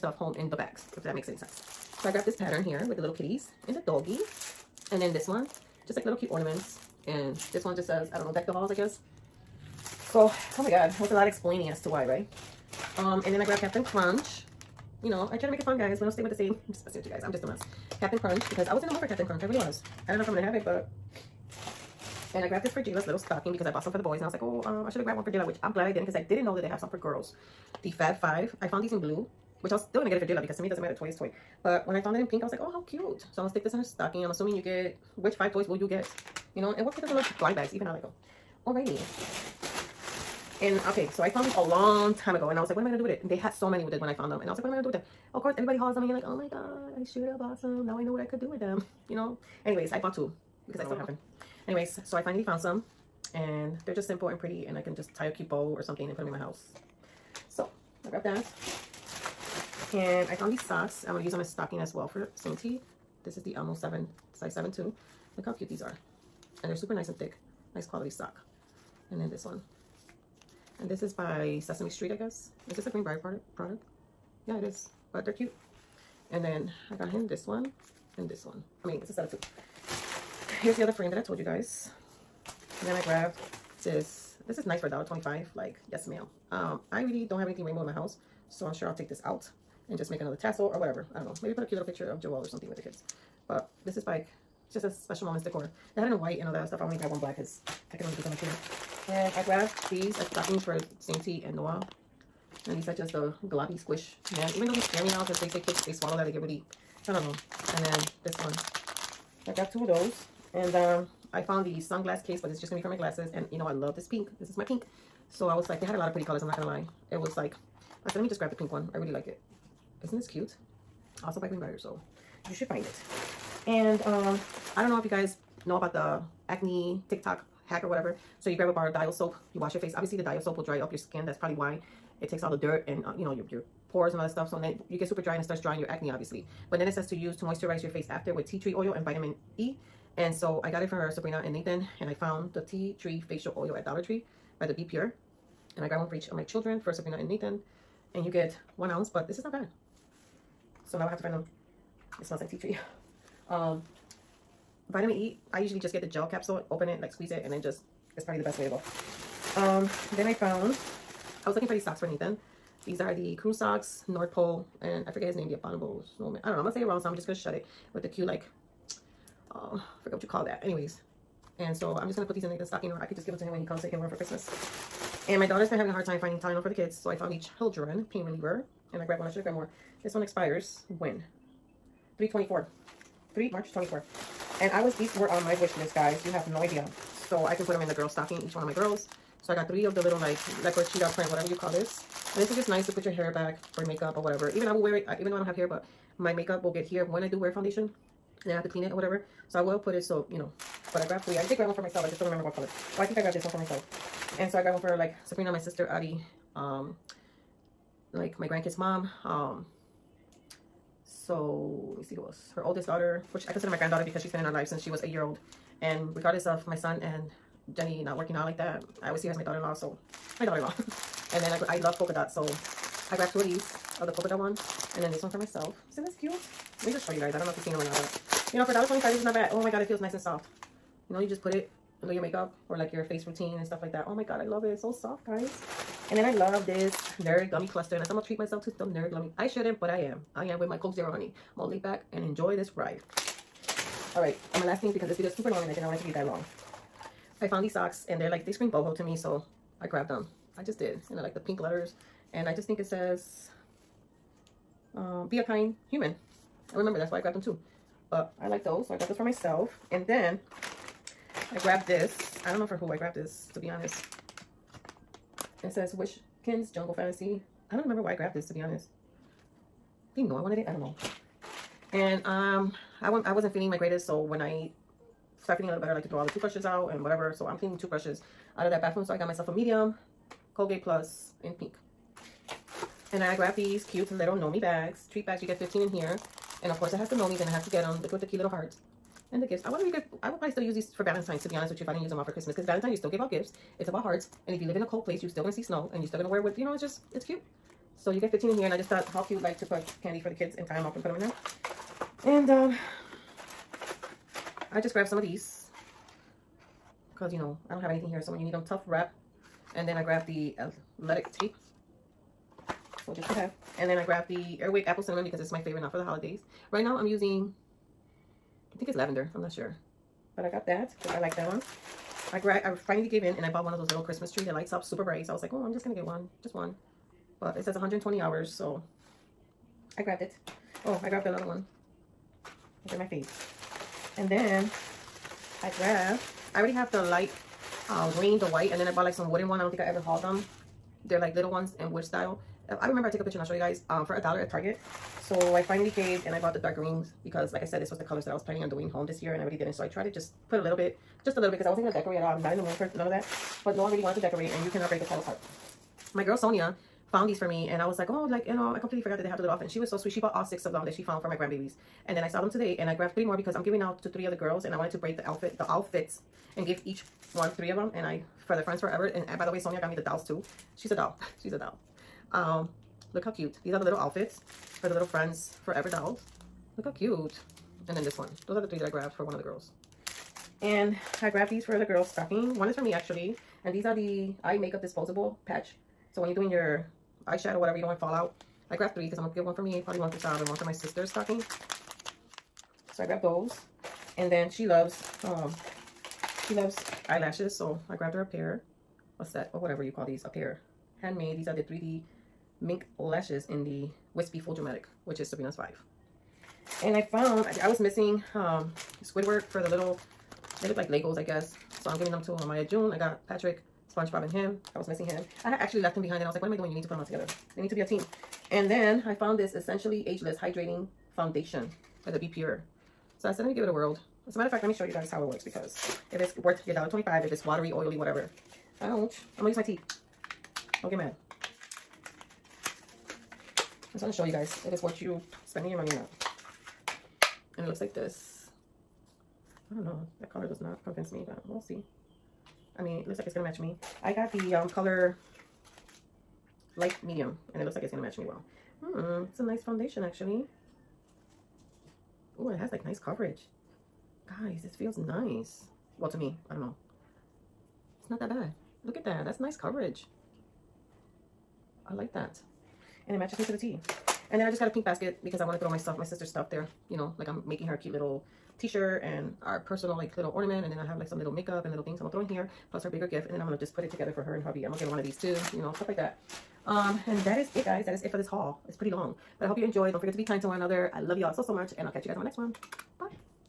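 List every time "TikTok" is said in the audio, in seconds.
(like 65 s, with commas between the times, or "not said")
127 s.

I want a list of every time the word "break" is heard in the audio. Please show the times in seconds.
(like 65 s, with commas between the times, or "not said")
354 s, 364 s.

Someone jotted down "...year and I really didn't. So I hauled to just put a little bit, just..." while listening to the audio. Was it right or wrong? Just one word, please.
wrong.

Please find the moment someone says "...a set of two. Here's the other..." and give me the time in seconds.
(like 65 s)
79 s.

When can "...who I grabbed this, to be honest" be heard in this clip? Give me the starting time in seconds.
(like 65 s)
262 s.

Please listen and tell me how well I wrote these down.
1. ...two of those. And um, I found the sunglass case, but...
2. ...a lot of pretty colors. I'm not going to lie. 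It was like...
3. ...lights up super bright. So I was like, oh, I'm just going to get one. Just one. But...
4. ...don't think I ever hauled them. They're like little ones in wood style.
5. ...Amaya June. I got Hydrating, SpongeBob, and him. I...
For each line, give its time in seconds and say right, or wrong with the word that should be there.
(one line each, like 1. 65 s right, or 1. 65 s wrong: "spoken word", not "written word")
1. 109 s right
2. 115 s right
3. 324 s right
4. 339 s right
5. 412 s wrong: "Patrick", not "Hydrating".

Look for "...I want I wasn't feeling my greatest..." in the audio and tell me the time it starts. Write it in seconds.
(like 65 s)
273 s.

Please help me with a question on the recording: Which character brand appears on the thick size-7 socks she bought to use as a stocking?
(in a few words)
Elmo.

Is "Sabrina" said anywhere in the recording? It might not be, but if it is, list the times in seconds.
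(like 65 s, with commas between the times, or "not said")
141 s, 146 s, 205 s, 405 s.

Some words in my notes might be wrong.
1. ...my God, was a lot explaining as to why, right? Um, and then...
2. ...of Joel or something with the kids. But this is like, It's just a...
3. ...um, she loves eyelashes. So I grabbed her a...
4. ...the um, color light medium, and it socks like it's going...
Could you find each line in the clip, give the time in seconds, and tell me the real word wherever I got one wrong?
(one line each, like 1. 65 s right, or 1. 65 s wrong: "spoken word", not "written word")
1. 10 s right
2. 92 s right
3. 395 s right
4. 444 s wrong: "looks", not "socks".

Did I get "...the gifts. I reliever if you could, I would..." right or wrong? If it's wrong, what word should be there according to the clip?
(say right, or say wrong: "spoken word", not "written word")
wrong: "wonder", not "reliever".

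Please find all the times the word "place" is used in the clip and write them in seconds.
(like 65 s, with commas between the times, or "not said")
295 s.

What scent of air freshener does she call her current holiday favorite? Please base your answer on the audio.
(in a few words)
Apple Cinnamon.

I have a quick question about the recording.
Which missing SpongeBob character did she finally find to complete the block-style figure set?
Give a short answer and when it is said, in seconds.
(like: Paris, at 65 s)
Squidward, at 409 s.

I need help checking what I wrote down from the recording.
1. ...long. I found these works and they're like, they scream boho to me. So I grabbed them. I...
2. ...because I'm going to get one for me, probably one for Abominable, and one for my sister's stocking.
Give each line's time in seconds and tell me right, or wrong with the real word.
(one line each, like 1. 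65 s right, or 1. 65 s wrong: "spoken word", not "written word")
1. 246 s wrong: "socks", not "works"
2. 389 s wrong: "Sab", not "Abominable".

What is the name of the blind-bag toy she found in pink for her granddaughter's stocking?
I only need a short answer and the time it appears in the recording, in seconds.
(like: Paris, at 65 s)
The Fab Five, at 27 s.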